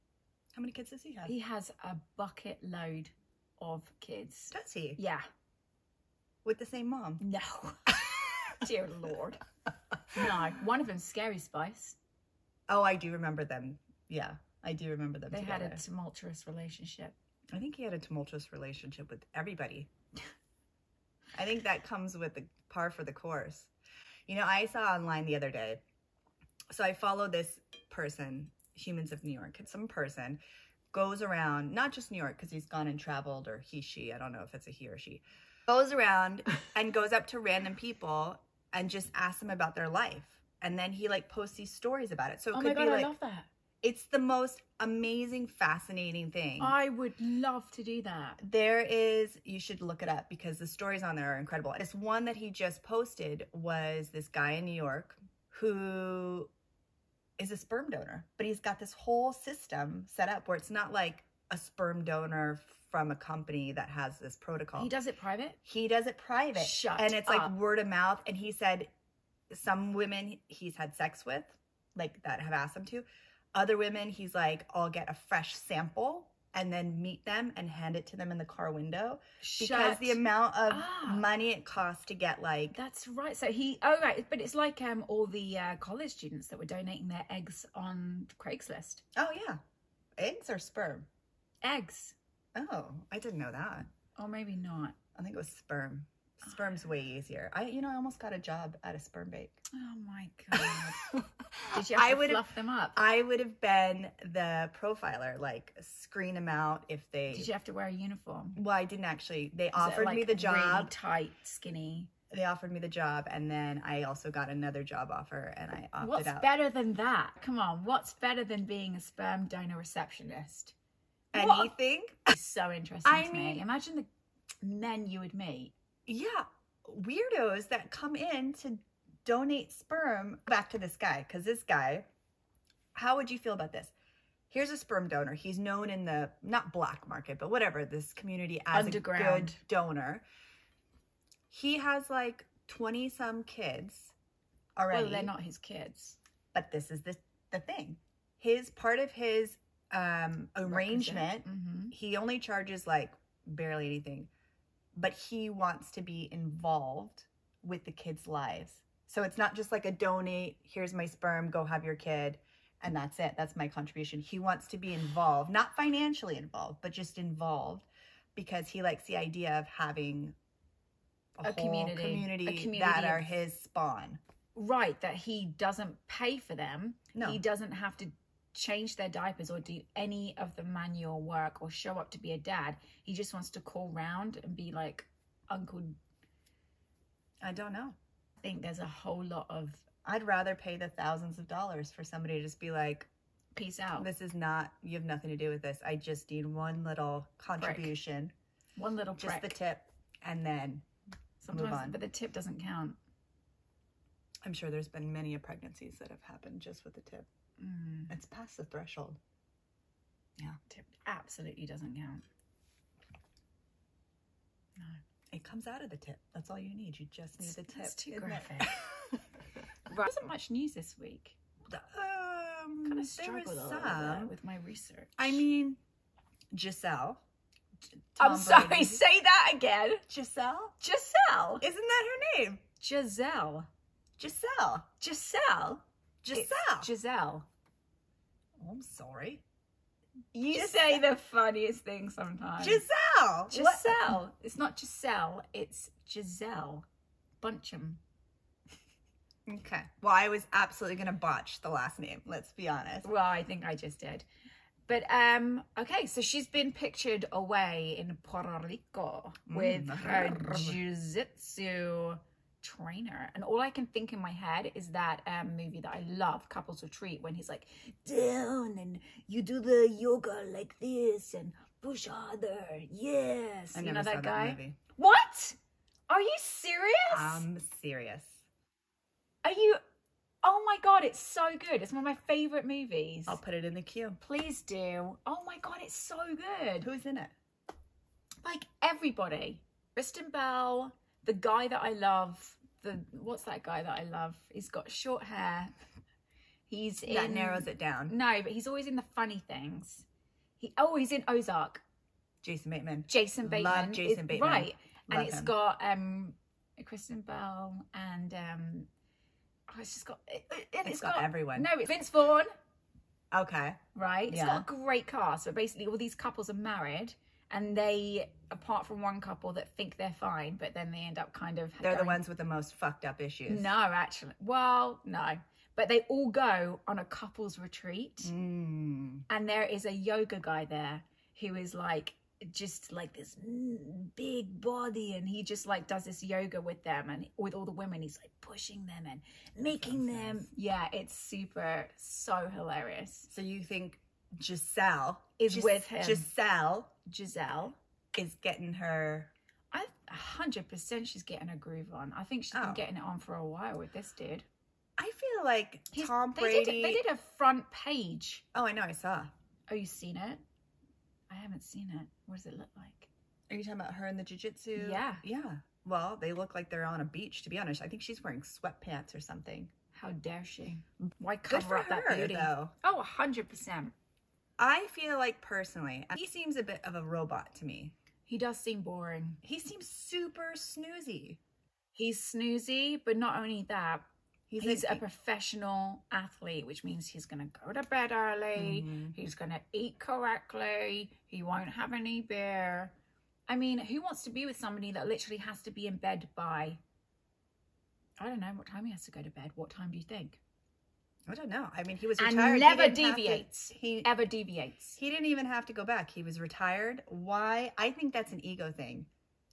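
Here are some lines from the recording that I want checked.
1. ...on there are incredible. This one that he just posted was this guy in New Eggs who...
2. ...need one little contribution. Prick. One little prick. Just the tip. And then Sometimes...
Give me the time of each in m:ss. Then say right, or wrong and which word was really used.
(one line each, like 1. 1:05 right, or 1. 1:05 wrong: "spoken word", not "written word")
1. 0:51 wrong: "York", not "Eggs"
2. 3:16 right.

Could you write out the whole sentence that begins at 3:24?
I'm sure there's been many pregnancies that have happened just with the tip.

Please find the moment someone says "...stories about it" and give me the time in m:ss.
0:41.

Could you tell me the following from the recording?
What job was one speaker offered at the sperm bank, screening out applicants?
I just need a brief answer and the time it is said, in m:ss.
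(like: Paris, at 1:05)
profiler, at 1:44.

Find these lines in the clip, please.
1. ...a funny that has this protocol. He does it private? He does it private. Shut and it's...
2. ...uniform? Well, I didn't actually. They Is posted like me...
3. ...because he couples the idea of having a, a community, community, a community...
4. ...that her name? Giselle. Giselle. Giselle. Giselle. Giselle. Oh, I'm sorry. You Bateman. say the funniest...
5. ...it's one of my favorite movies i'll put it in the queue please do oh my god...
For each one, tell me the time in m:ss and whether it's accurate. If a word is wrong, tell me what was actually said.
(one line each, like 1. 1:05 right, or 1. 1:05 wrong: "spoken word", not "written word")
1. 1:03 wrong: "company", not "funny"
2. 1:47 wrong: "offered", not "posted"
3. 2:48 wrong: "likes", not "couples"
4. 3:51 wrong: "Giselle", not "Bateman"
5. 4:41 right.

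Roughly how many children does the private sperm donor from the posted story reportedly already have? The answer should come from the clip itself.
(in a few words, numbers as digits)
twenty some.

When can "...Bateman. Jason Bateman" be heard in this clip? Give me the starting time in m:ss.
5:02.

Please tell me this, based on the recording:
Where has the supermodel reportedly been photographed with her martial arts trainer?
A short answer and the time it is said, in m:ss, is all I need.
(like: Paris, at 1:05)
Puerto Rico, at 4:18.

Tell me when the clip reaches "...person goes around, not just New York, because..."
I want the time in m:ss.
0:29.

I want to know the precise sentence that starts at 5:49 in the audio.
I hundred percent she's getting her groove on.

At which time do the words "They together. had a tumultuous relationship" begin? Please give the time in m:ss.
0:15.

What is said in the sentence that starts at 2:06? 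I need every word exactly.
Yeah, weirdos that come in to donate sperm back to this guy because this guy.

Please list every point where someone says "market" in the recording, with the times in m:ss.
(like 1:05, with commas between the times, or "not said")
2:17.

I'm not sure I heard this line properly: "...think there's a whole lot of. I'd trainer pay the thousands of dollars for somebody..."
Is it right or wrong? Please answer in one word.
wrong.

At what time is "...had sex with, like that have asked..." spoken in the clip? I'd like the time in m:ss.
1:10.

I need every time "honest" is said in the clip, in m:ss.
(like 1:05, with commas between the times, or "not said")
4:12, 6:07.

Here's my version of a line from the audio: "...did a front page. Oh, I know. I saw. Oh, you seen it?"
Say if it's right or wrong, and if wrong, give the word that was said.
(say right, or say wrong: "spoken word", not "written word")
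right.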